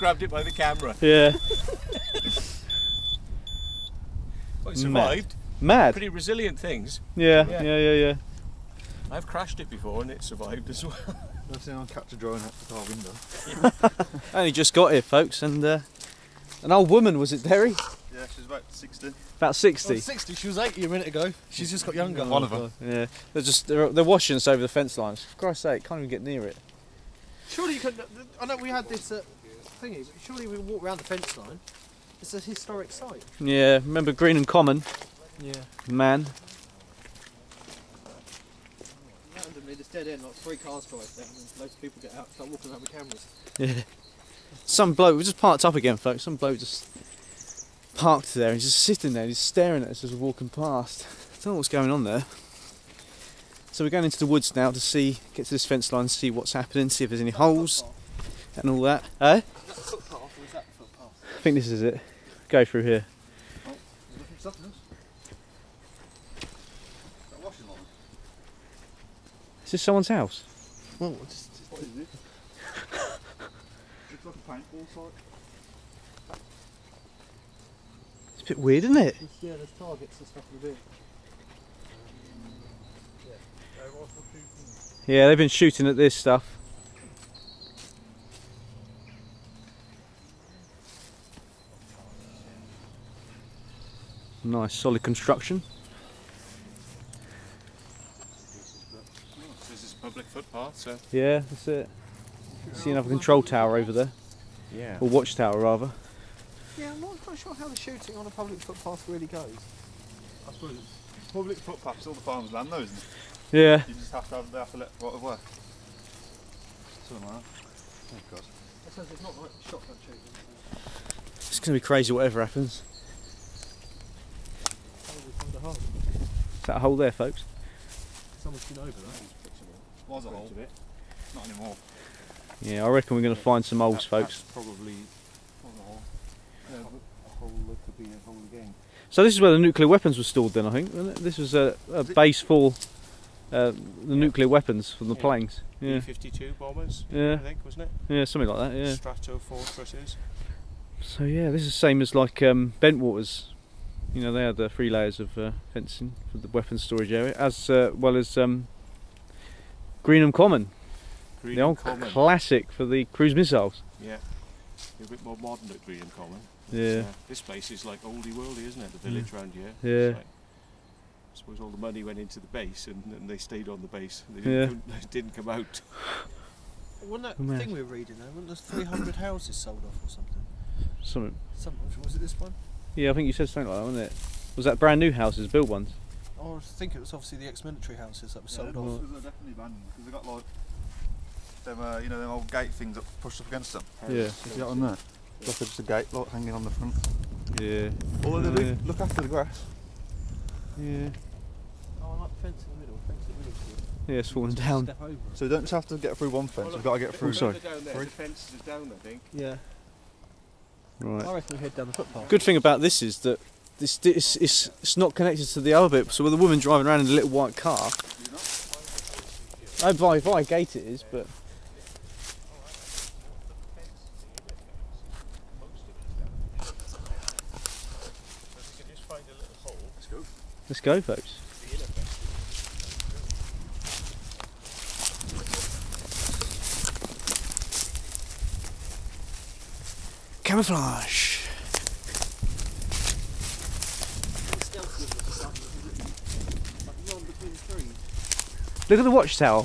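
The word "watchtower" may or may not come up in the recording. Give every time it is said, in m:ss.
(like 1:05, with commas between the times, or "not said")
1:45, 4:09.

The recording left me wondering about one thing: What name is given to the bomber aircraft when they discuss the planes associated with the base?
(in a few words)
Stratofortresses.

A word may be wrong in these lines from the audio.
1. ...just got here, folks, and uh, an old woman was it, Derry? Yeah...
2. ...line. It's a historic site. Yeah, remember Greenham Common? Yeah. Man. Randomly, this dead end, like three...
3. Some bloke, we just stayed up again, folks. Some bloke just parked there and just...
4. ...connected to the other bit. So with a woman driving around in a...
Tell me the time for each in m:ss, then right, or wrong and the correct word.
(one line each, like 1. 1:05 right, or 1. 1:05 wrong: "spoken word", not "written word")
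1. 0:14 right
2. 0:31 right
3. 0:44 wrong: "parked", not "stayed"
4. 3:35 right.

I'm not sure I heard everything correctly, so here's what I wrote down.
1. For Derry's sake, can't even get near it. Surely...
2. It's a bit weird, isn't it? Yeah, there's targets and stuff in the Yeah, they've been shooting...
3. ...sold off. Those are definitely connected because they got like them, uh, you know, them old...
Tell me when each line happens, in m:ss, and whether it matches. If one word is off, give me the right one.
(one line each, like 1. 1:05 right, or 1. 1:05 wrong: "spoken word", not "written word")
1. 0:25 wrong: "Christ", not "Derry"
2. 1:18 right
3. 3:08 wrong: "abandoned", not "connected".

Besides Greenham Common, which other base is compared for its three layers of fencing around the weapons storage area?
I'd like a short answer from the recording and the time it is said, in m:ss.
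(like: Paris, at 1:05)
Bentwaters, at 2:32.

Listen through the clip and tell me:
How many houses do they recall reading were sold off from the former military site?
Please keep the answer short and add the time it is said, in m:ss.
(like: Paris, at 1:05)
300, at 2:58.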